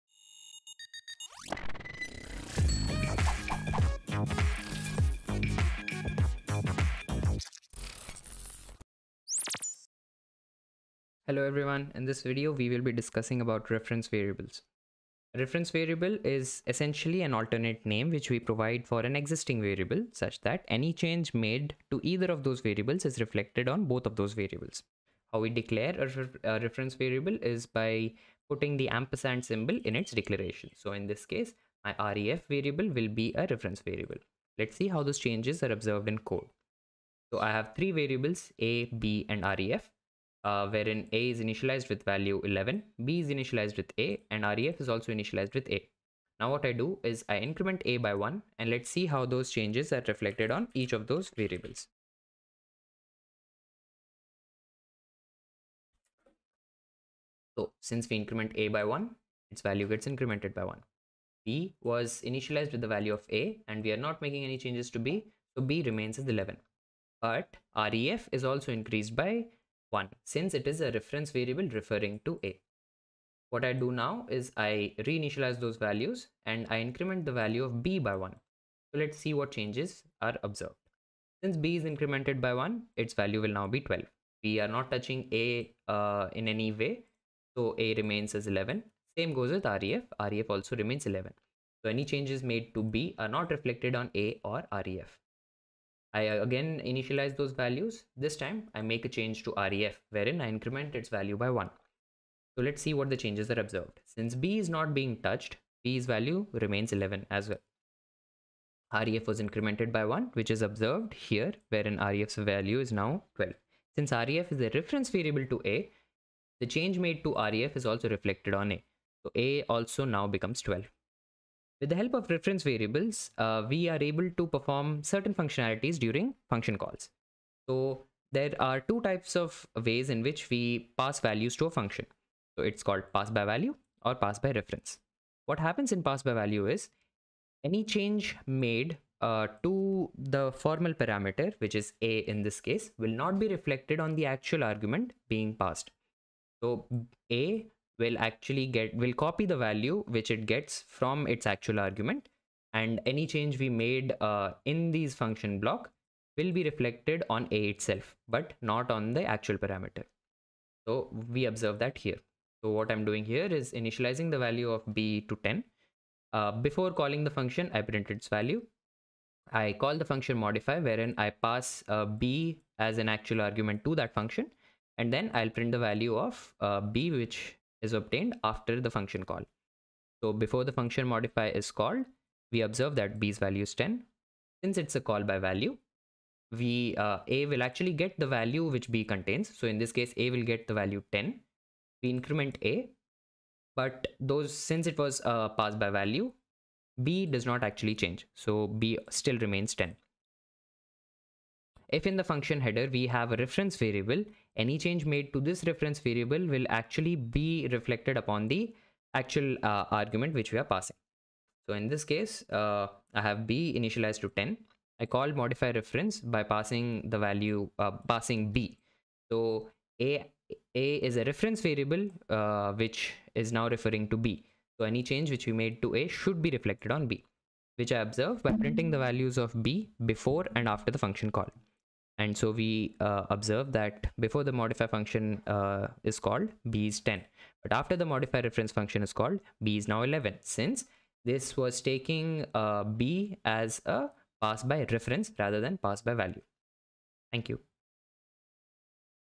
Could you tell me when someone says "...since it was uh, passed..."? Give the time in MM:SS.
03:14.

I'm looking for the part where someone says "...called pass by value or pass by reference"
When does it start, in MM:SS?
02:12.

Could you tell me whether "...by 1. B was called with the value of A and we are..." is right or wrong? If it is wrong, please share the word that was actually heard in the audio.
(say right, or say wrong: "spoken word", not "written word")
wrong: "initialized", not "called".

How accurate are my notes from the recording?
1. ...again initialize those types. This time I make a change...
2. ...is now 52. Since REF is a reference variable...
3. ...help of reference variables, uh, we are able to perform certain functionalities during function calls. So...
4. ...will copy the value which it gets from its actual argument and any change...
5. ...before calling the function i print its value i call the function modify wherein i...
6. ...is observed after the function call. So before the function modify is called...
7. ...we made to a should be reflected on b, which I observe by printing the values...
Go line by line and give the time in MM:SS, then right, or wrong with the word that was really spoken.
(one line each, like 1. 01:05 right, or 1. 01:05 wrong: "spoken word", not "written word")
1. 01:36 wrong: "values", not "types"
2. 01:52 wrong: "12", not "52"
3. 02:01 right
4. 02:29 right
5. 02:46 right
6. 02:57 wrong: "obtained", not "observed"
7. 03:45 right.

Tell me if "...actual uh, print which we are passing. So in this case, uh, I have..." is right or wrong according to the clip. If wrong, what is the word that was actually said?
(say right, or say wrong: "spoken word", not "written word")
wrong: "argument", not "print".